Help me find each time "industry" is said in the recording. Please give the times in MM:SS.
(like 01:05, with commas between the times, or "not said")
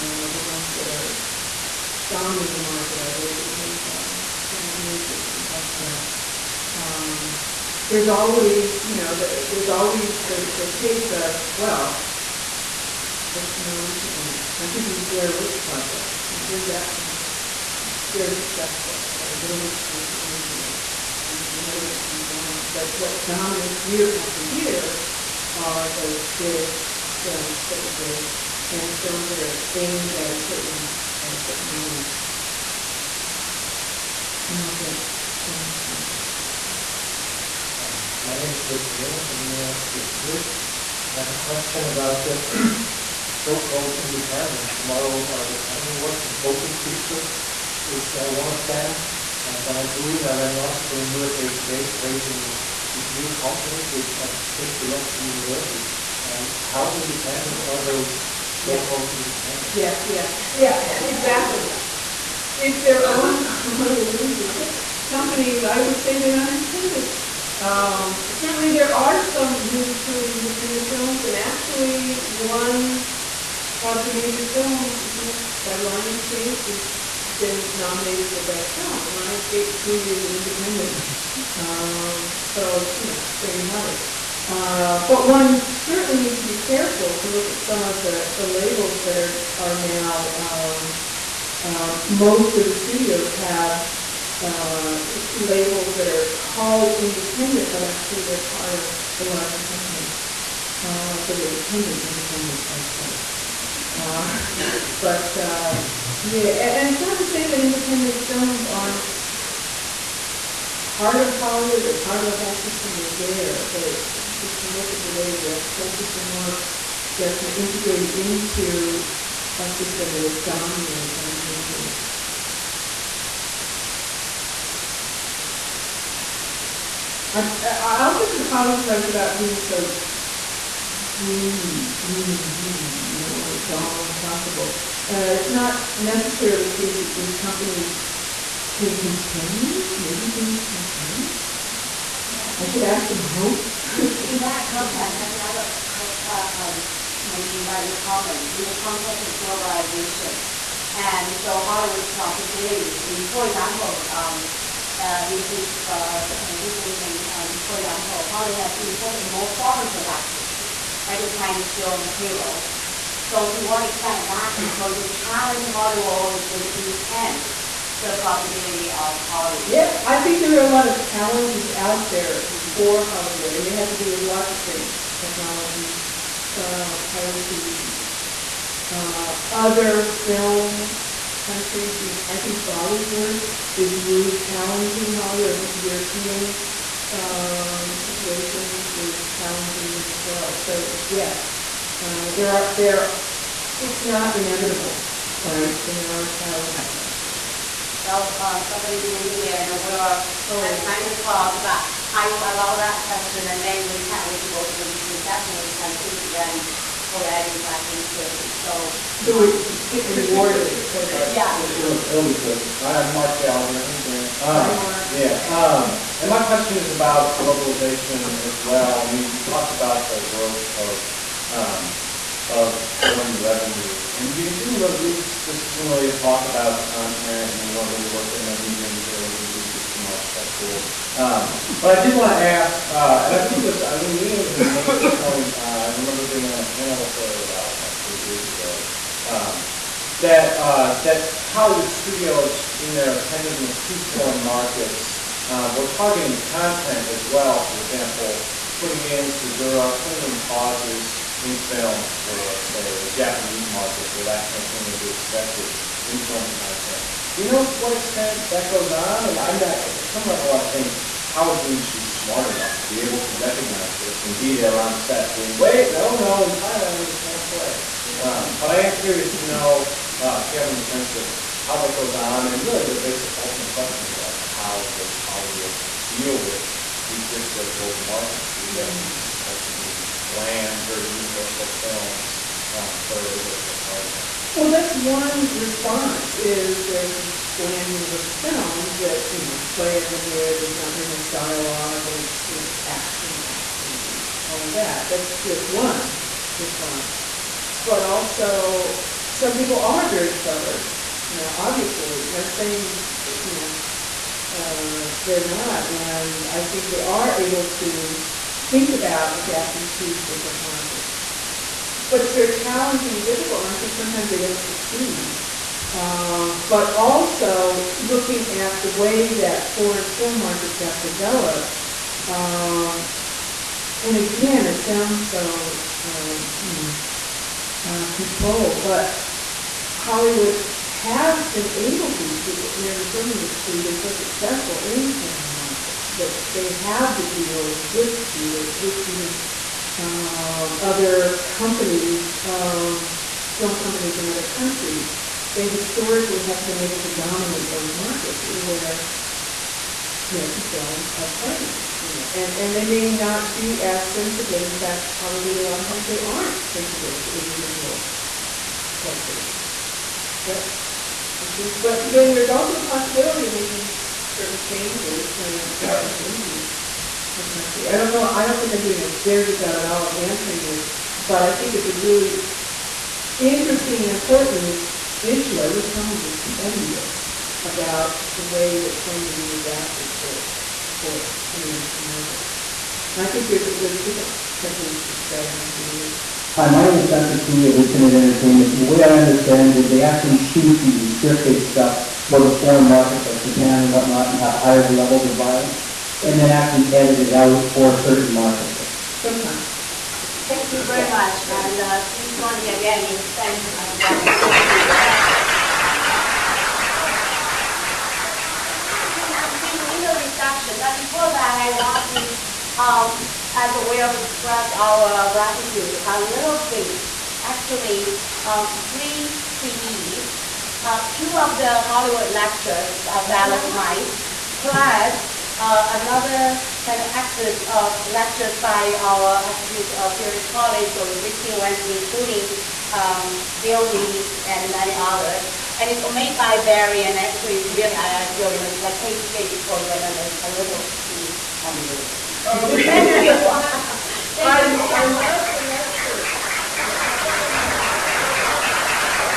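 04:21, 05:33.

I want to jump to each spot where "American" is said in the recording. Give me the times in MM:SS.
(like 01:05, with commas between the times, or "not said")
05:32, 05:50.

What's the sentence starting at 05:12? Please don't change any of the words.
But it's very challenging and difficult, and I think sometimes they don't succeed.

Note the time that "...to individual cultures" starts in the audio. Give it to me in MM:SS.
05:57.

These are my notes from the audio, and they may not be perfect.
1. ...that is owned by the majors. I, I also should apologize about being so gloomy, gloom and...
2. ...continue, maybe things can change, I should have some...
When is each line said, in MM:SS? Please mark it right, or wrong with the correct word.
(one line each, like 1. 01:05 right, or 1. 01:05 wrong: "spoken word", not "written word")
1. 02:00 wrong: "dominated", not "owned"
2. 02:18 right.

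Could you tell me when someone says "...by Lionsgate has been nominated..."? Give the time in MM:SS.
01:15.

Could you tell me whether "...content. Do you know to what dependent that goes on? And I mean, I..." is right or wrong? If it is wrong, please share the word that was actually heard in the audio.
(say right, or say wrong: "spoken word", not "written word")
wrong: "extent", not "dependent".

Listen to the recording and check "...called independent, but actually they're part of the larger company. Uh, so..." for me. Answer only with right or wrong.
right.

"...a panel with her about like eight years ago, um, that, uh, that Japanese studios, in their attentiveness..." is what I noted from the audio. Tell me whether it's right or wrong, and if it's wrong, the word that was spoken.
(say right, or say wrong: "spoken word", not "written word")
wrong: "Hollywood", not "Japanese".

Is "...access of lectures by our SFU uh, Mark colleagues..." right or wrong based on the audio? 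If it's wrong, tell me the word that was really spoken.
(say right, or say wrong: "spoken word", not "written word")
wrong: "Pierce", not "Mark".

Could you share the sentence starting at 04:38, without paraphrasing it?
We have these ultimately bland, very universal films um, that are able to target that.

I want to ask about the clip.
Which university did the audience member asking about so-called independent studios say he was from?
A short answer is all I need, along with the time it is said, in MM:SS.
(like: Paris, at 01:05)
University of Zurich, at 00:39.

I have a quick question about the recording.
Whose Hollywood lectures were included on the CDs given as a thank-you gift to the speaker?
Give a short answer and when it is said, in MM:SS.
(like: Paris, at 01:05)
Dallas Smythe, at 07:03.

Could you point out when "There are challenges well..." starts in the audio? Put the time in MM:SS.
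03:15.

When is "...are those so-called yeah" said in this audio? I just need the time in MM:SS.
00:57.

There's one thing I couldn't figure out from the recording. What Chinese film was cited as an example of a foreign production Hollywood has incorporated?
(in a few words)
Hero.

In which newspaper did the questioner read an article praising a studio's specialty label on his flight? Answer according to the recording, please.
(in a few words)
USA Today.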